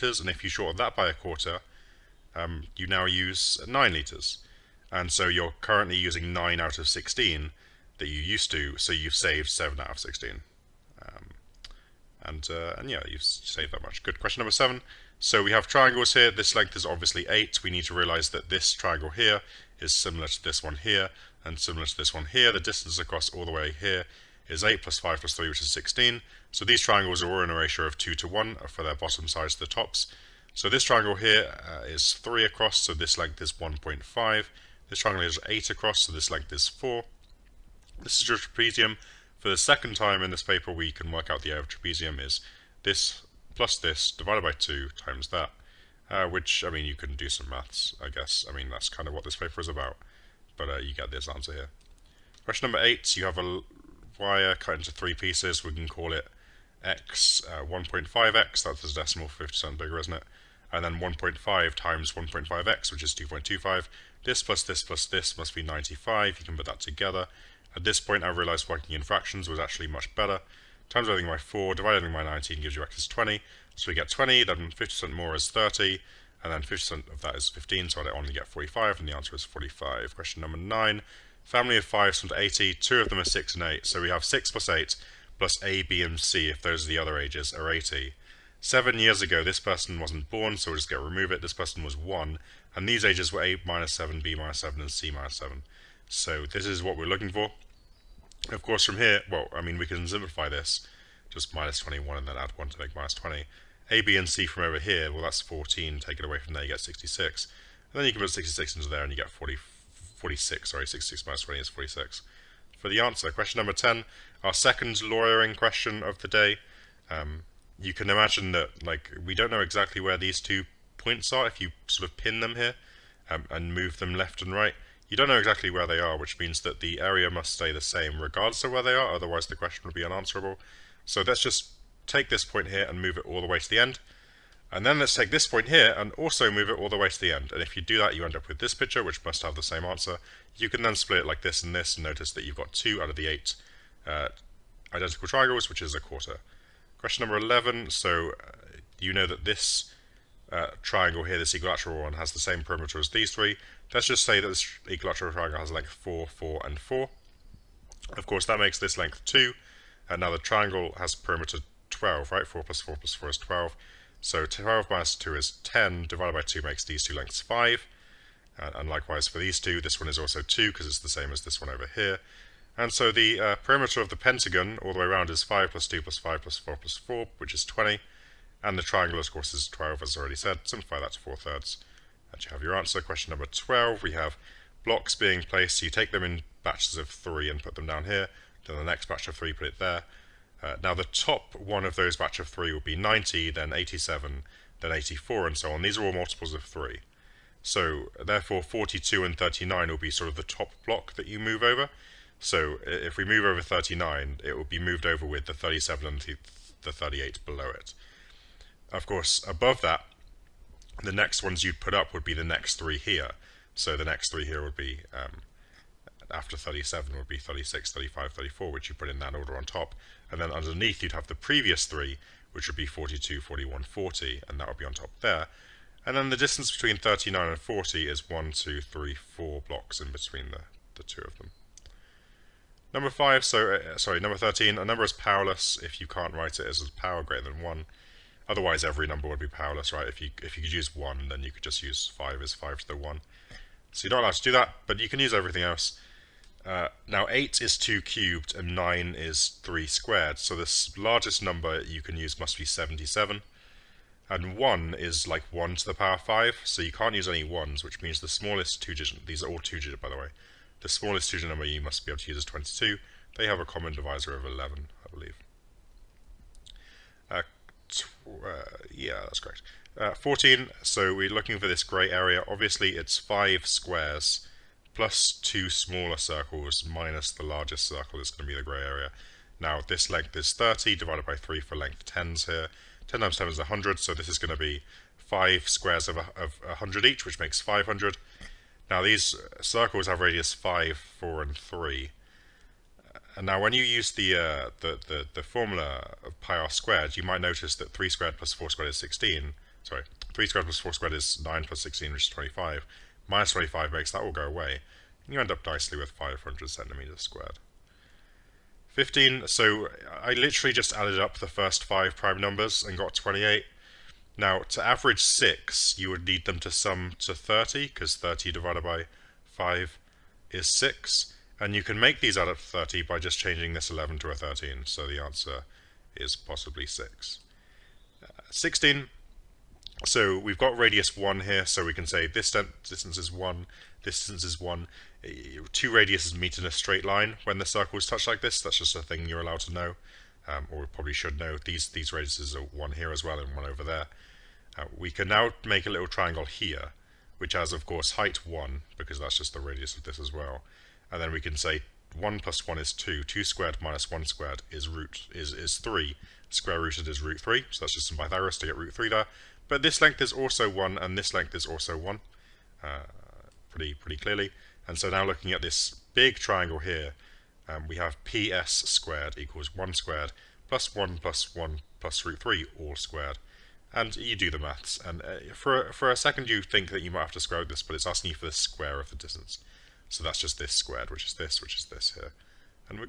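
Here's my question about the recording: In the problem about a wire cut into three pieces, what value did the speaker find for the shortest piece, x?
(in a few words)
20.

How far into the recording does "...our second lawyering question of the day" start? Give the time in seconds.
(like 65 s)
114 s.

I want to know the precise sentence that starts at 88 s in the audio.
Seven years ago, this person wasn't born, so we'll just get remove it.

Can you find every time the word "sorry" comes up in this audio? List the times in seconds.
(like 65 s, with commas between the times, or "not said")
110 s, 233 s, 299 s.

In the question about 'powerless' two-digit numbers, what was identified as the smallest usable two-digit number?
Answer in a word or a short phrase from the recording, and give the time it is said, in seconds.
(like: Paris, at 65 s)
22, at 262 s.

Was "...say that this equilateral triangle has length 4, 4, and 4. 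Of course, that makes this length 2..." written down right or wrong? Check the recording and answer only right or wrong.
right.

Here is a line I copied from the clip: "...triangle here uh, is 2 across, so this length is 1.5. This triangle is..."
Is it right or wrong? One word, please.
wrong.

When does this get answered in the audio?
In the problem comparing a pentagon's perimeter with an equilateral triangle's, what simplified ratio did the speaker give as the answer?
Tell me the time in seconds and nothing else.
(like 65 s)
181 s.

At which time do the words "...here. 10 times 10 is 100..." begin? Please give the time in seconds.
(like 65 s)
282 s.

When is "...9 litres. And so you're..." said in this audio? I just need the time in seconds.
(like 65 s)
3 s.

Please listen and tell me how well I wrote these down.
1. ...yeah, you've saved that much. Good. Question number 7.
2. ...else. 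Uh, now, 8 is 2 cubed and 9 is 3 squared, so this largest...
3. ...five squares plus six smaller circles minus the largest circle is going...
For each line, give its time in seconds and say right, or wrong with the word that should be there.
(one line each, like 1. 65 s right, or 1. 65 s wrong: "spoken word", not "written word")
1. 12 s right
2. 245 s right
3. 273 s wrong: "two", not "six".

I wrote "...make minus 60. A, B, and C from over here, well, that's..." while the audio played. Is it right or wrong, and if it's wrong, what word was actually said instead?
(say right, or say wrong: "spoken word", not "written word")
wrong: "20", not "60".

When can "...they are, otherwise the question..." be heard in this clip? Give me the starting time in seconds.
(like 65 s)
128 s.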